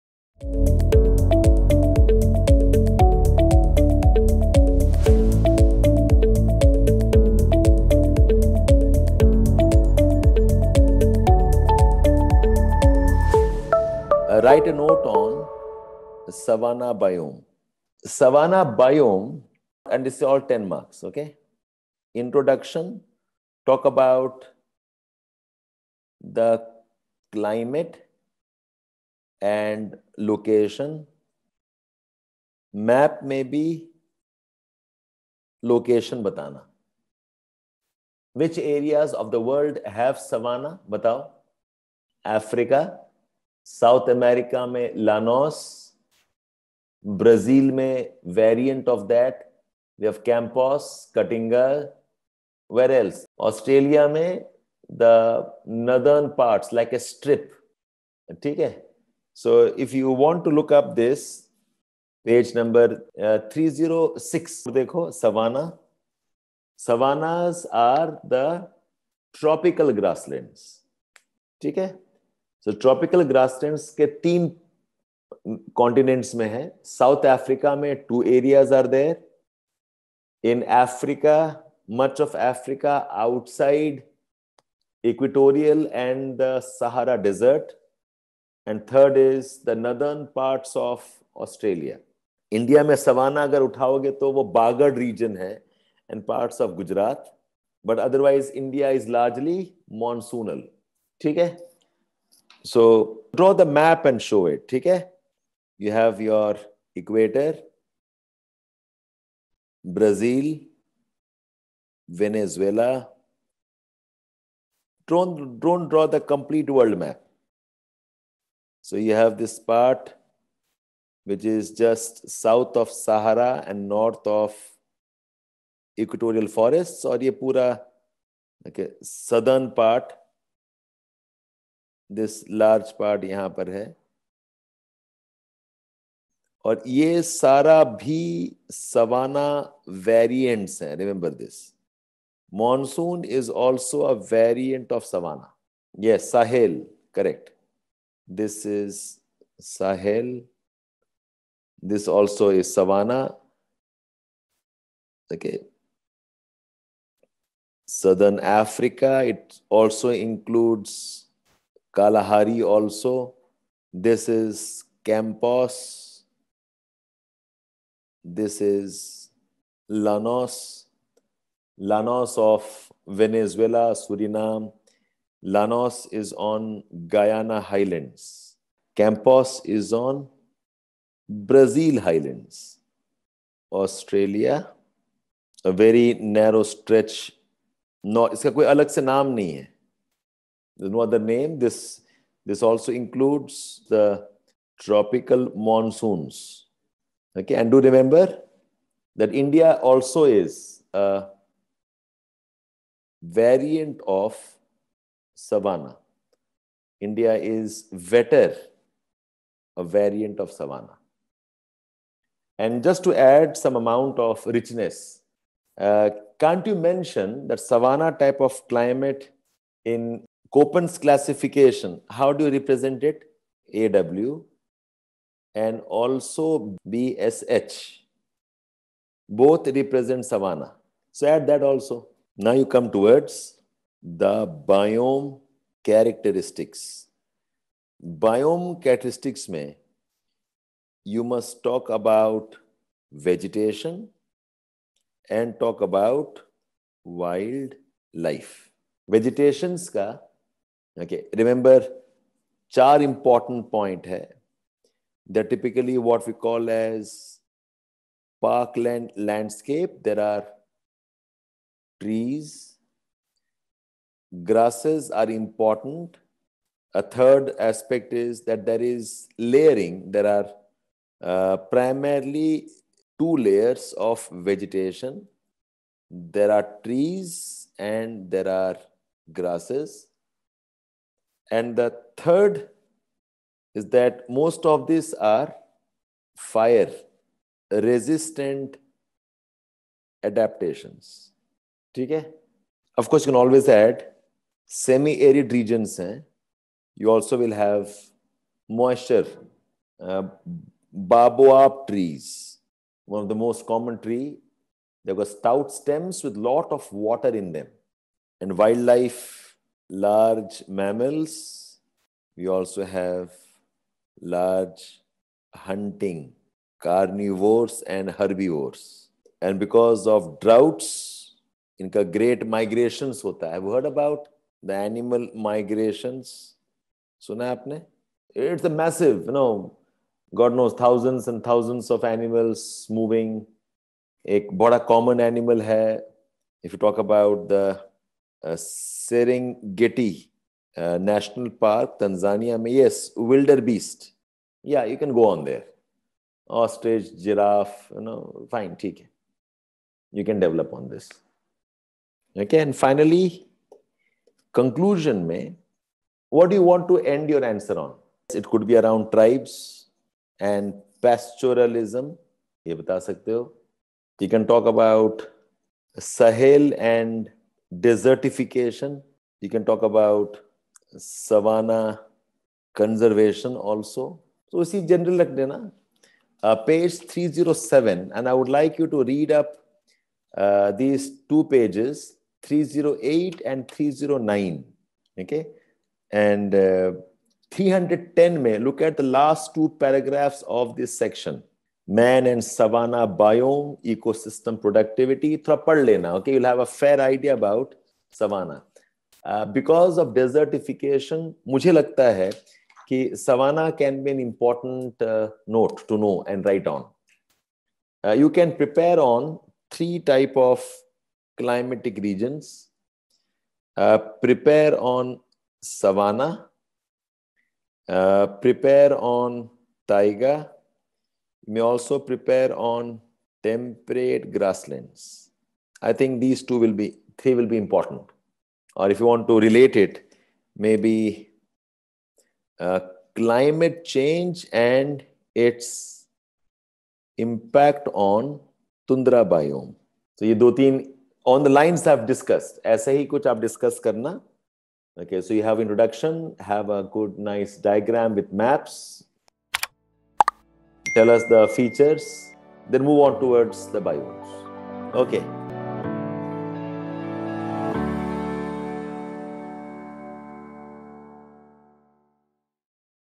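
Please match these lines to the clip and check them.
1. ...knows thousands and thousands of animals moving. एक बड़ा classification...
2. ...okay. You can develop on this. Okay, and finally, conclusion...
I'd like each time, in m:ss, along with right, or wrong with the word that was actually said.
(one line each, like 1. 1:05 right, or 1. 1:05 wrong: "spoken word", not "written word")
1. 5:30 wrong: "common", not "classification"
2. 5:48 right.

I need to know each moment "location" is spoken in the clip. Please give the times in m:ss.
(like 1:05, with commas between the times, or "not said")
0:30, 0:35.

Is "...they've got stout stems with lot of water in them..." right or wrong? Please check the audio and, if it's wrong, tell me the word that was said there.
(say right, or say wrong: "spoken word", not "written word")
right.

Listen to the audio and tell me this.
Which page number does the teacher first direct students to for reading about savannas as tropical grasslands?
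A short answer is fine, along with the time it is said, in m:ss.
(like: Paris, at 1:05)
306, at 1:02.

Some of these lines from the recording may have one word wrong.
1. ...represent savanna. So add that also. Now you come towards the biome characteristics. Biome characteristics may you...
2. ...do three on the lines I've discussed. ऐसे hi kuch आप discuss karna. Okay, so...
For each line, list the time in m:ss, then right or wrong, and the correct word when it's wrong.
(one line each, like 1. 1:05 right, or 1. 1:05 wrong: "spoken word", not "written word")
1. 3:49 right
2. 7:20 right.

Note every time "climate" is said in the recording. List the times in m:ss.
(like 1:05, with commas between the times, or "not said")
0:27, 3:38, 7:13.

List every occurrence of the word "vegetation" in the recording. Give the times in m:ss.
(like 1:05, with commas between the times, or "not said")
4:03, 4:09, 4:34.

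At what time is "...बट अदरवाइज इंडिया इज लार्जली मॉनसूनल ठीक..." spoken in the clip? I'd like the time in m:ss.
1:37.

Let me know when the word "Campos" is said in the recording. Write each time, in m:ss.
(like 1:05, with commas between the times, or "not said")
2:45, 2:58.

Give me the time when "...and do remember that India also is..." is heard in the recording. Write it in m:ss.
3:17.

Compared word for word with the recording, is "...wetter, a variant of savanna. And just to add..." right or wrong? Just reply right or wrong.
right.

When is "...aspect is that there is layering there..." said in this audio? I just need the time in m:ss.
4:27.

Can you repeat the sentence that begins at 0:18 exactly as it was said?
Savanna biome, and this is all 10 marks, okay?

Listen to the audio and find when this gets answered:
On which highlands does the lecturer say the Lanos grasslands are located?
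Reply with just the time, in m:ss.
2:57.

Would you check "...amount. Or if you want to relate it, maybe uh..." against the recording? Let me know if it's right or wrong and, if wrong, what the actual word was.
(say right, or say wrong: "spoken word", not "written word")
wrong: "important", not "amount".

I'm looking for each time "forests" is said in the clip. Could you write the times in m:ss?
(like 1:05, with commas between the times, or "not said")
2:06.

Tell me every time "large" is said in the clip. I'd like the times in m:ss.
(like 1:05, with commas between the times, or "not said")
5:09, 5:14.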